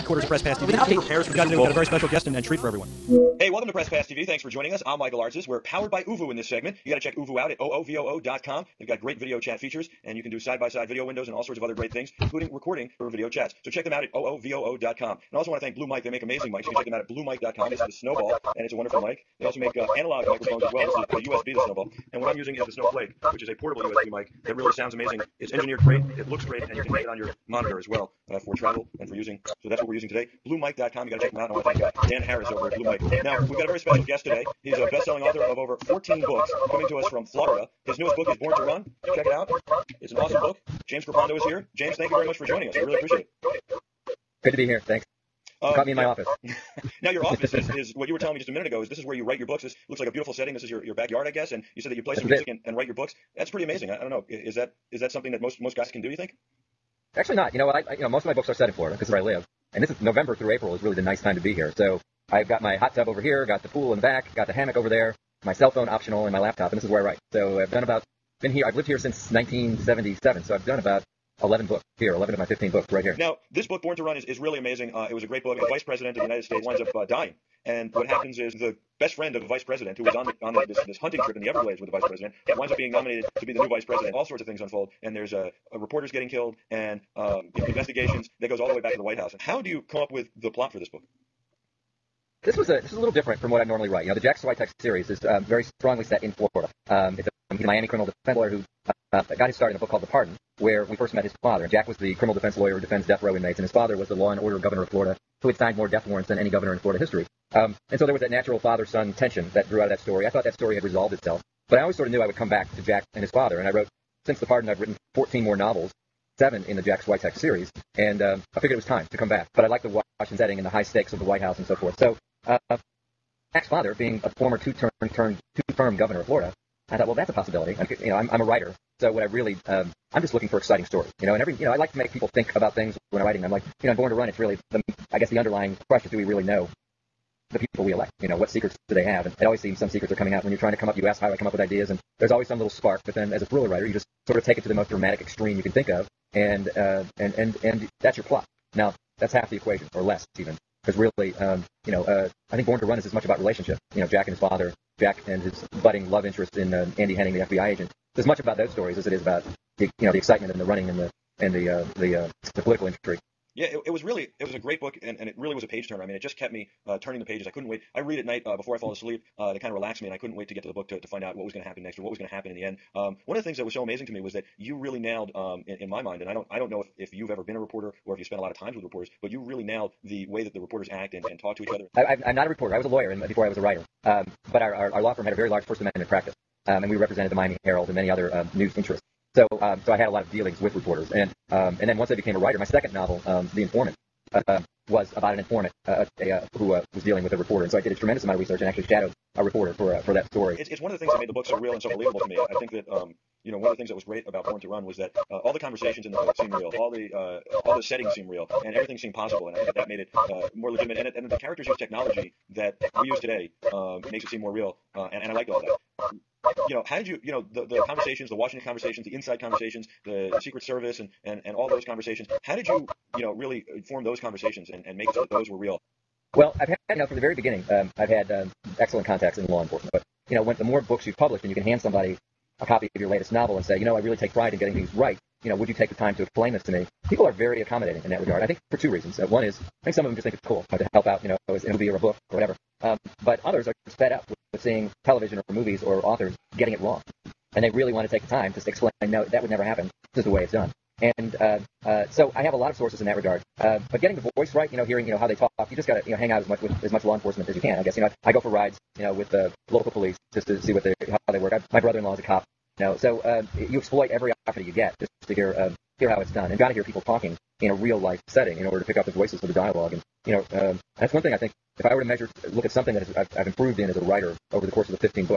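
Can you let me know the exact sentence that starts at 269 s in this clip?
And you know, um, that's one thing I think.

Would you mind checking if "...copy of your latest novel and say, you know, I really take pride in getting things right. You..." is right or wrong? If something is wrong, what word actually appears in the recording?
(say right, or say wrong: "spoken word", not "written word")
right.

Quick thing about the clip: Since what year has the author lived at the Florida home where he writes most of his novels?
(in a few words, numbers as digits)
1977.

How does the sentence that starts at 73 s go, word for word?
Now, this book, Born to Run, is, is really amazing.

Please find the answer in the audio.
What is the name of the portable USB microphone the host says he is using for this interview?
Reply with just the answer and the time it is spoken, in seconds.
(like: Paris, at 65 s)
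Snowflake, at 22 s.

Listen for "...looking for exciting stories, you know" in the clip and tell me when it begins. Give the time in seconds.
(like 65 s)
130 s.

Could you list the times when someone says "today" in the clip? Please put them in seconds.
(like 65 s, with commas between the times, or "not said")
1 s, 30 s, 34 s, 213 s.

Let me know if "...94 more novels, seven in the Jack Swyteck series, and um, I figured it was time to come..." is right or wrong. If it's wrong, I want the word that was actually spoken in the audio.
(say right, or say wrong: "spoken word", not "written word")
wrong: "14", not "94".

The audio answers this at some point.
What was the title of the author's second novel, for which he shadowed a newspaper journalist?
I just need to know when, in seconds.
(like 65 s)
193 s.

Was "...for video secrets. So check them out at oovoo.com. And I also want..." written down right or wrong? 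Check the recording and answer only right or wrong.
wrong.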